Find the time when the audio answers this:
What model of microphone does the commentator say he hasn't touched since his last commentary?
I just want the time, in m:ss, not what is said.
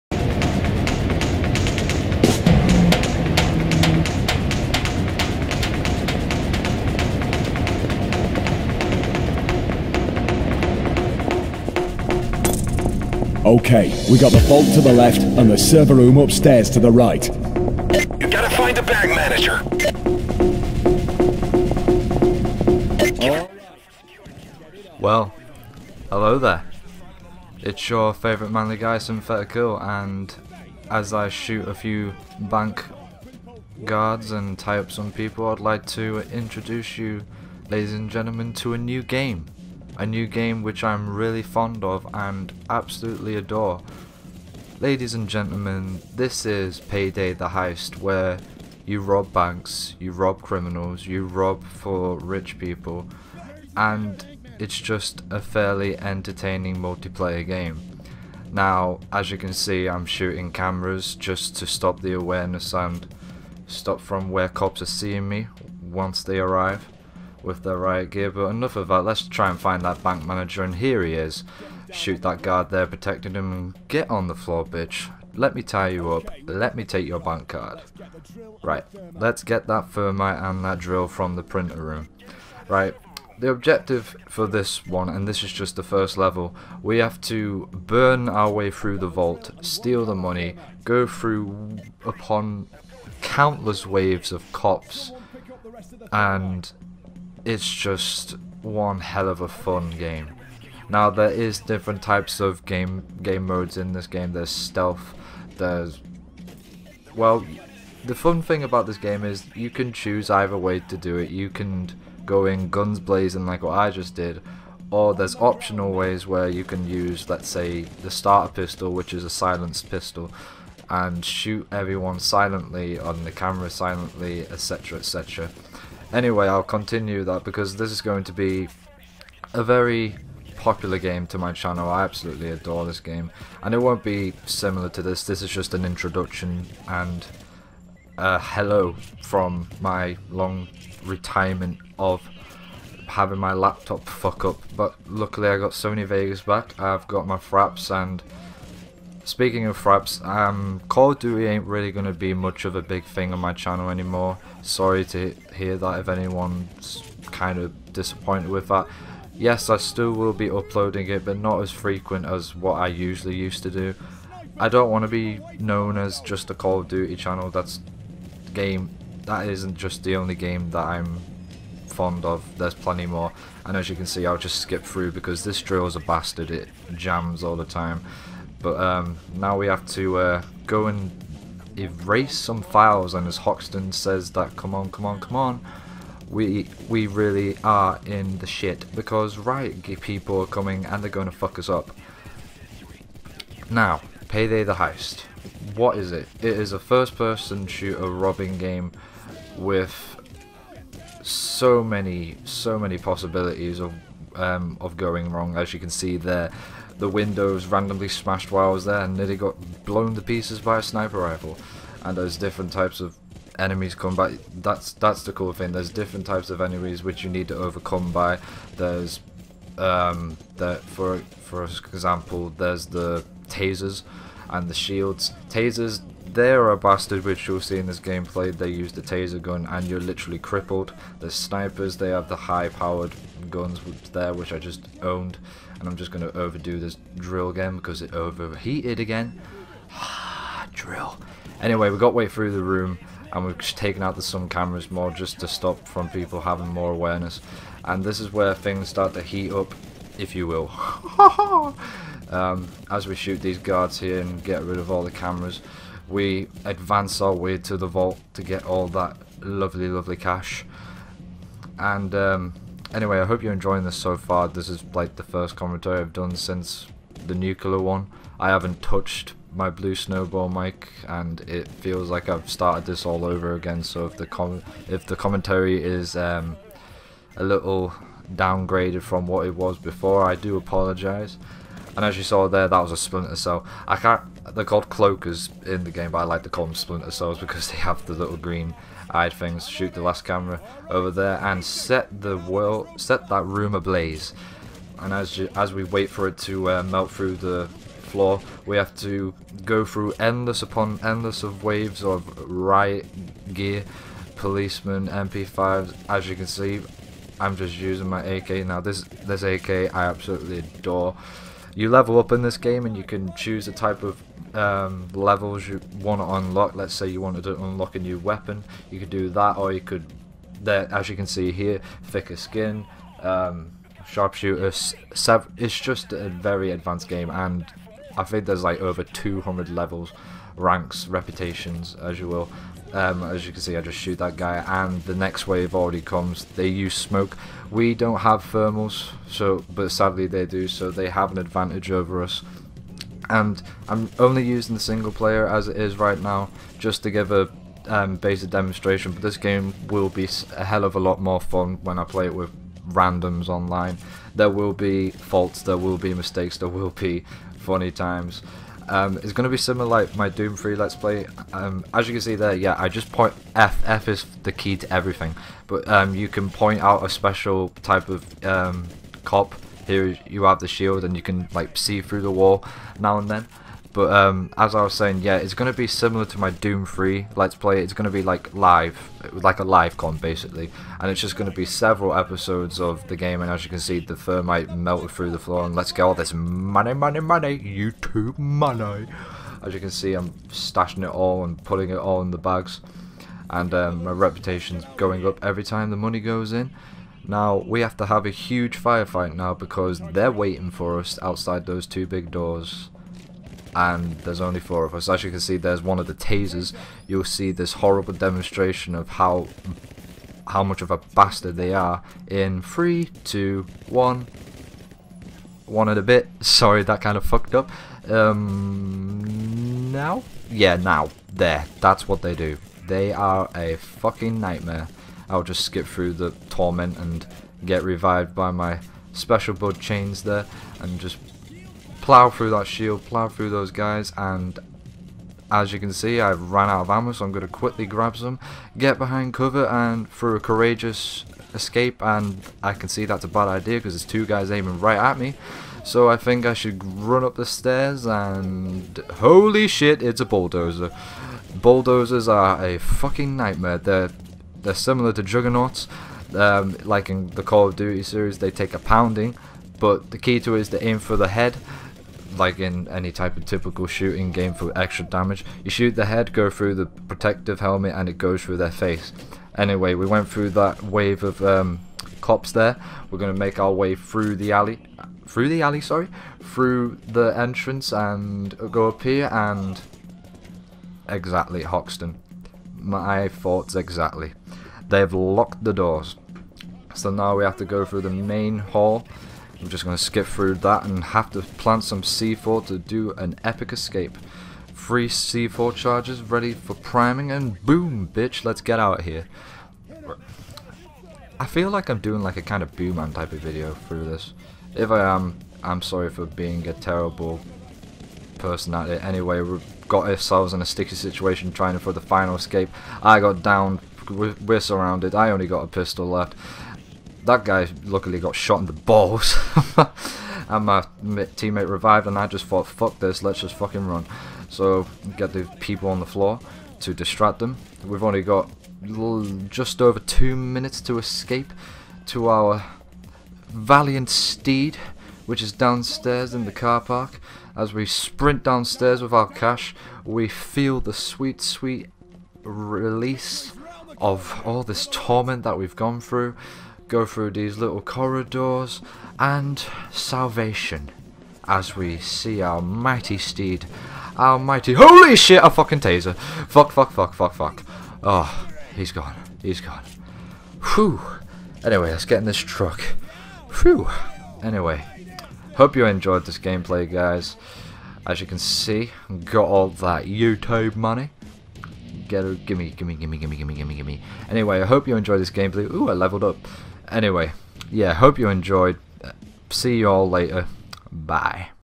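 4:29.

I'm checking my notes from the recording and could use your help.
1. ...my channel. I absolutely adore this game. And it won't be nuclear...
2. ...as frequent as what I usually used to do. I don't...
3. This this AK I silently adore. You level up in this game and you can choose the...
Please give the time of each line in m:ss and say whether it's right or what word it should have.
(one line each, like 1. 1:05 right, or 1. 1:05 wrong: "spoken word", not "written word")
1. 2:11 wrong: "similar", not "nuclear"
2. 2:41 right
3. 5:08 wrong: "absolutely", not "silently".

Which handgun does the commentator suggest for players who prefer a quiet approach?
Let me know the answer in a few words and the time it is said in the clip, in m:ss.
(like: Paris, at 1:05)
starter pistol, at 1:58.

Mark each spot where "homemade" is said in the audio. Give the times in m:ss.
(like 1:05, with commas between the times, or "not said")
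not said.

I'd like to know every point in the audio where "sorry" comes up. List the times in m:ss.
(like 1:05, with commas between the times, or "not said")
2:34, 6:56, 7:55, 8:25.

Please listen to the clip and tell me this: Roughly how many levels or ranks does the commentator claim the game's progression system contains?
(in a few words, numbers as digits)
over 200.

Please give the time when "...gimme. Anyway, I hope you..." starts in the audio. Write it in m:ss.
9:33.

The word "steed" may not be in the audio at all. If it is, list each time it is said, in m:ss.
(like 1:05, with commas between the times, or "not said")
8:54, 9:13.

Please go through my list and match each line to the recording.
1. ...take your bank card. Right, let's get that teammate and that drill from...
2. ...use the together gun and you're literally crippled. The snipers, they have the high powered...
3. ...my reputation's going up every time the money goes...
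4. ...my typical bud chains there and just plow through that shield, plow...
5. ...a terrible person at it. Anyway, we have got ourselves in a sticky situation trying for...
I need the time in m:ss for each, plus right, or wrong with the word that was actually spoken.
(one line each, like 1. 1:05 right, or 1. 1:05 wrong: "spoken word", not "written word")
1. 1:16 wrong: "thermite", not "teammate"
2. 3:48 wrong: "taser", not "together"
3. 6:34 right
4. 7:08 wrong: "special", not "typical"
5. 8:26 right.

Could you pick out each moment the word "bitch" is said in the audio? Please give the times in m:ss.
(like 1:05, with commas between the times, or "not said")
1:14, 8:18.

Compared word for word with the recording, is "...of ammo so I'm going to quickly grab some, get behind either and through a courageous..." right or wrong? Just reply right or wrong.
wrong.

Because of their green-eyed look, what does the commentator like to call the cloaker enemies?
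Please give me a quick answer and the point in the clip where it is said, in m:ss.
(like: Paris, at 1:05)
splinter cells, at 4:46.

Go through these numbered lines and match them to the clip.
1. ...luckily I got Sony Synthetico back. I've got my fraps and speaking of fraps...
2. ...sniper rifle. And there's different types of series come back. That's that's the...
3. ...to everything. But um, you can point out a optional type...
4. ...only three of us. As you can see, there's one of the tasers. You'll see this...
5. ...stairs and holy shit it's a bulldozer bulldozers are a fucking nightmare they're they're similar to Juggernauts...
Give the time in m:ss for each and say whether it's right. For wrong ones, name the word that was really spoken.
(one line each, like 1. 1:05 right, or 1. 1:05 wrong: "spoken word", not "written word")
1. 2:25 wrong: "Vegas", not "Synthetico"
2. 3:30 wrong: "enemies", not "series"
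3. 6:04 wrong: "special", not "optional"
4. 6:44 wrong: "four", not "three"
5. 7:27 right.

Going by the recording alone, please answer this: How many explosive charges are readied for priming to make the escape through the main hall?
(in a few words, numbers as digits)
3.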